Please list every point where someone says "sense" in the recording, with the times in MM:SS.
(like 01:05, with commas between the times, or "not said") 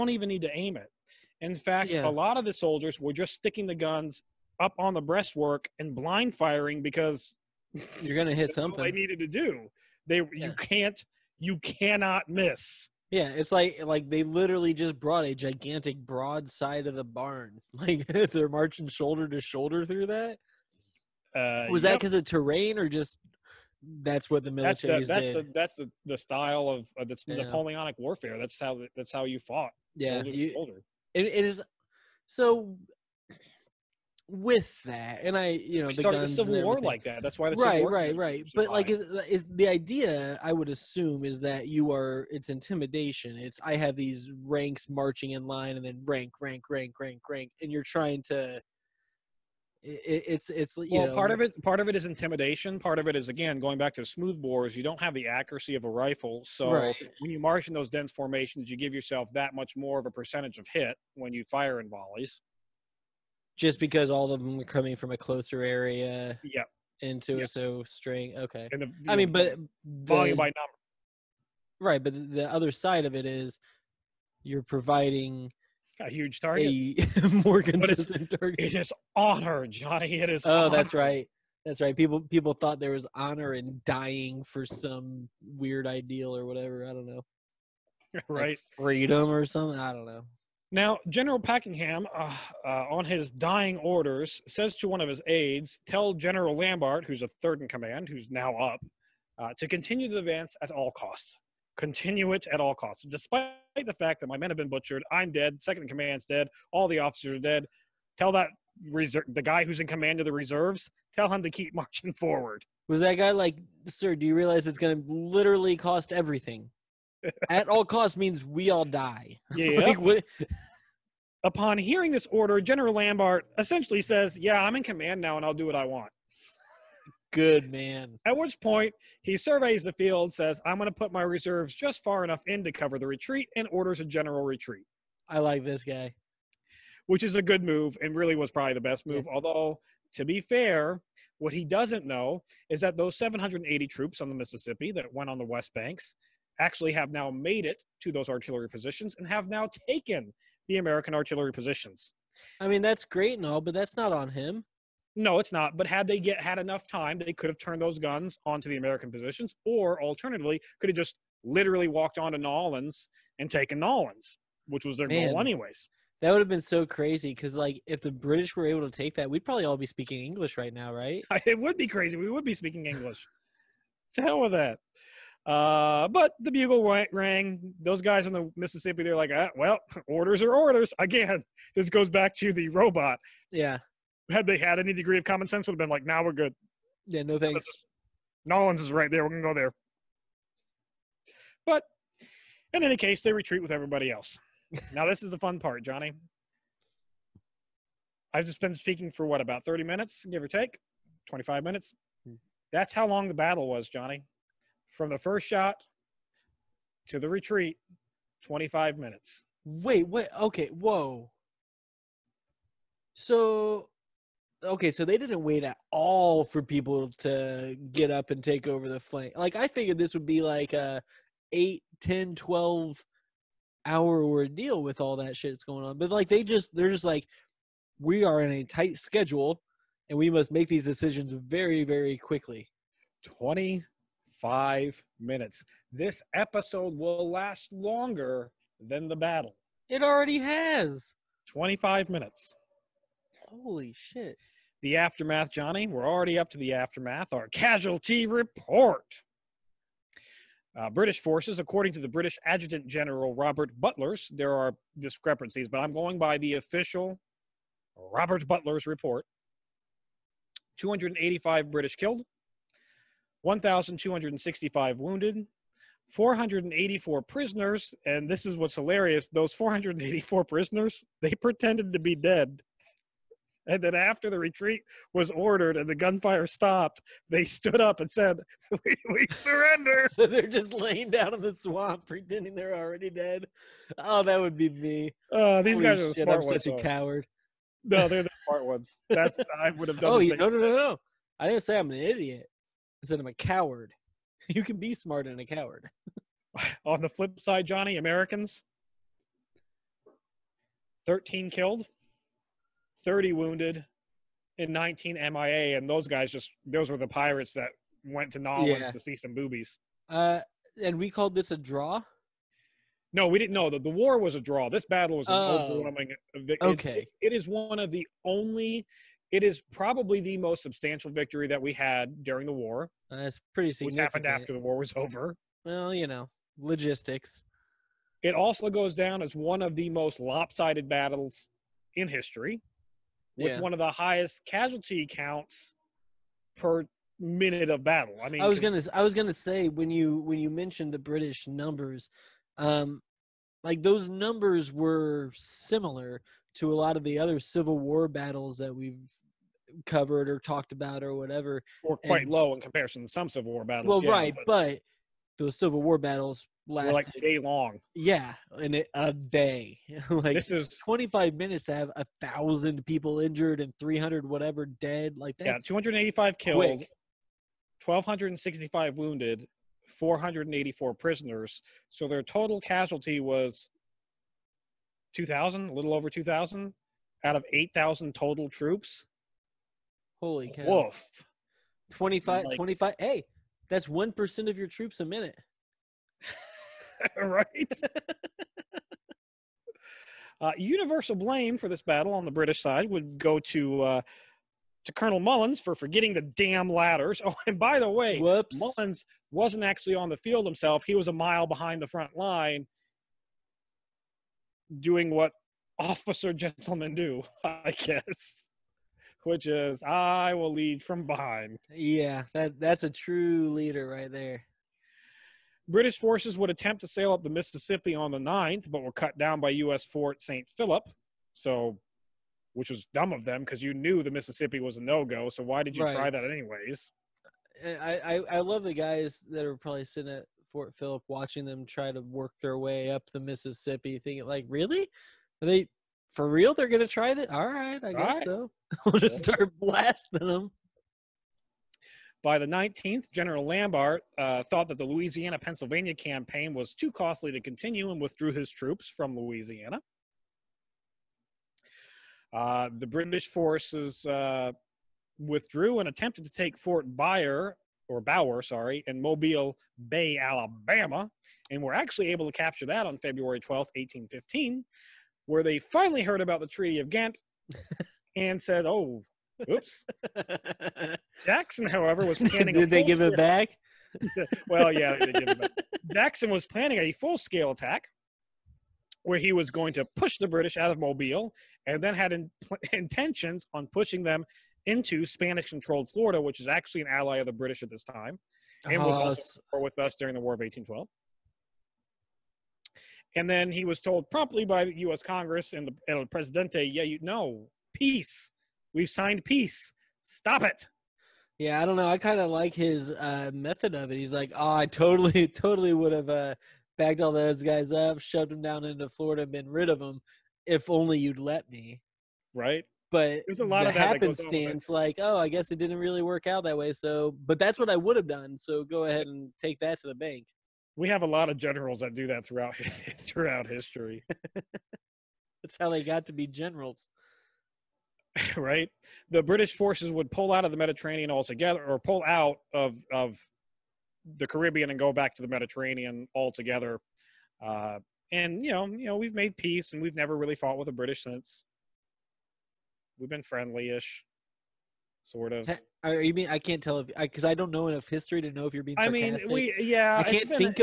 03:05.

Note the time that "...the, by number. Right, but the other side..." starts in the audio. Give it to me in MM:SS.
01:10.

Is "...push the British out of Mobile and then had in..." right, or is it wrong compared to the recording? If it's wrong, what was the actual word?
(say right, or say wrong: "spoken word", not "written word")
right.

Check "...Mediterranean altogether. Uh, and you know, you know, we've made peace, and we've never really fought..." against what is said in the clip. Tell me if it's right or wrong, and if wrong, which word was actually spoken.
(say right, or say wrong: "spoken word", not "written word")
right.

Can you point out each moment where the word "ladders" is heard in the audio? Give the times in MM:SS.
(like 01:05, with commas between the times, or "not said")
06:36.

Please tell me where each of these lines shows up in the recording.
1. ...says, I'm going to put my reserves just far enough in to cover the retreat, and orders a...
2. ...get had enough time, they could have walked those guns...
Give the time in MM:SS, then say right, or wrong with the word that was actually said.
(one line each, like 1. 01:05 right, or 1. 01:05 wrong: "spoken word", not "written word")
1. 02:10 right
2. 02:36 wrong: "turned", not "walked".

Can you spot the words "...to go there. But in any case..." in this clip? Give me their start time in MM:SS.
03:09.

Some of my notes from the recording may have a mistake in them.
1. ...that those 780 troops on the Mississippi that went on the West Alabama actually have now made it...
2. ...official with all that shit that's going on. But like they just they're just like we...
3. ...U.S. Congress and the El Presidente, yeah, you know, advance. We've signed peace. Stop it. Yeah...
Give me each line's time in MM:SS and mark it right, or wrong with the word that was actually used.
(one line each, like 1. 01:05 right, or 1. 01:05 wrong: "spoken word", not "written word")
1. 02:22 wrong: "Banks", not "Alabama"
2. 03:44 wrong: "ordeal", not "official"
3. 08:14 wrong: "peace", not "advance".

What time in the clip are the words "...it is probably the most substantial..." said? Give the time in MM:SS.
05:19.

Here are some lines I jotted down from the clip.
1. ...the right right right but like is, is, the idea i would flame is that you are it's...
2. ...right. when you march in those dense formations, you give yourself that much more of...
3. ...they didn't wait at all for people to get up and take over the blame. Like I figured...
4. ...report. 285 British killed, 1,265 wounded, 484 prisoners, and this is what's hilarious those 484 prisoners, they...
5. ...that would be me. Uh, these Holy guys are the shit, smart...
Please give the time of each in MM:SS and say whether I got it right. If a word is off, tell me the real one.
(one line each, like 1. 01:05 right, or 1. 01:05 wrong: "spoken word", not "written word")
1. 00:37 wrong: "assume", not "flame"
2. 00:56 right
3. 03:35 wrong: "flame", not "blame"
4. 04:18 right
5. 04:44 right.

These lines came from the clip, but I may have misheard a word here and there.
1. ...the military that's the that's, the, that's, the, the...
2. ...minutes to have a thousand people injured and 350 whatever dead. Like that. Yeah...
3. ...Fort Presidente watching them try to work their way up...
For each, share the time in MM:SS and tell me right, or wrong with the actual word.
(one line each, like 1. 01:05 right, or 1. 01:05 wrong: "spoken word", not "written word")
1. 00:24 right
2. 06:01 wrong: "300", not "350"
3. 07:10 wrong: "Philip", not "Presidente".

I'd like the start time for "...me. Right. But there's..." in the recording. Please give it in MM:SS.
08:31.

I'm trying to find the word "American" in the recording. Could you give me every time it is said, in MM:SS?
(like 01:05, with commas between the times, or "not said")
02:30, 02:38, 04:57.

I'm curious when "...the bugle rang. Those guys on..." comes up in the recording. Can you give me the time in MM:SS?
02:56.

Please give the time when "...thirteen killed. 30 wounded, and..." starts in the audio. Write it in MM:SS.
05:01.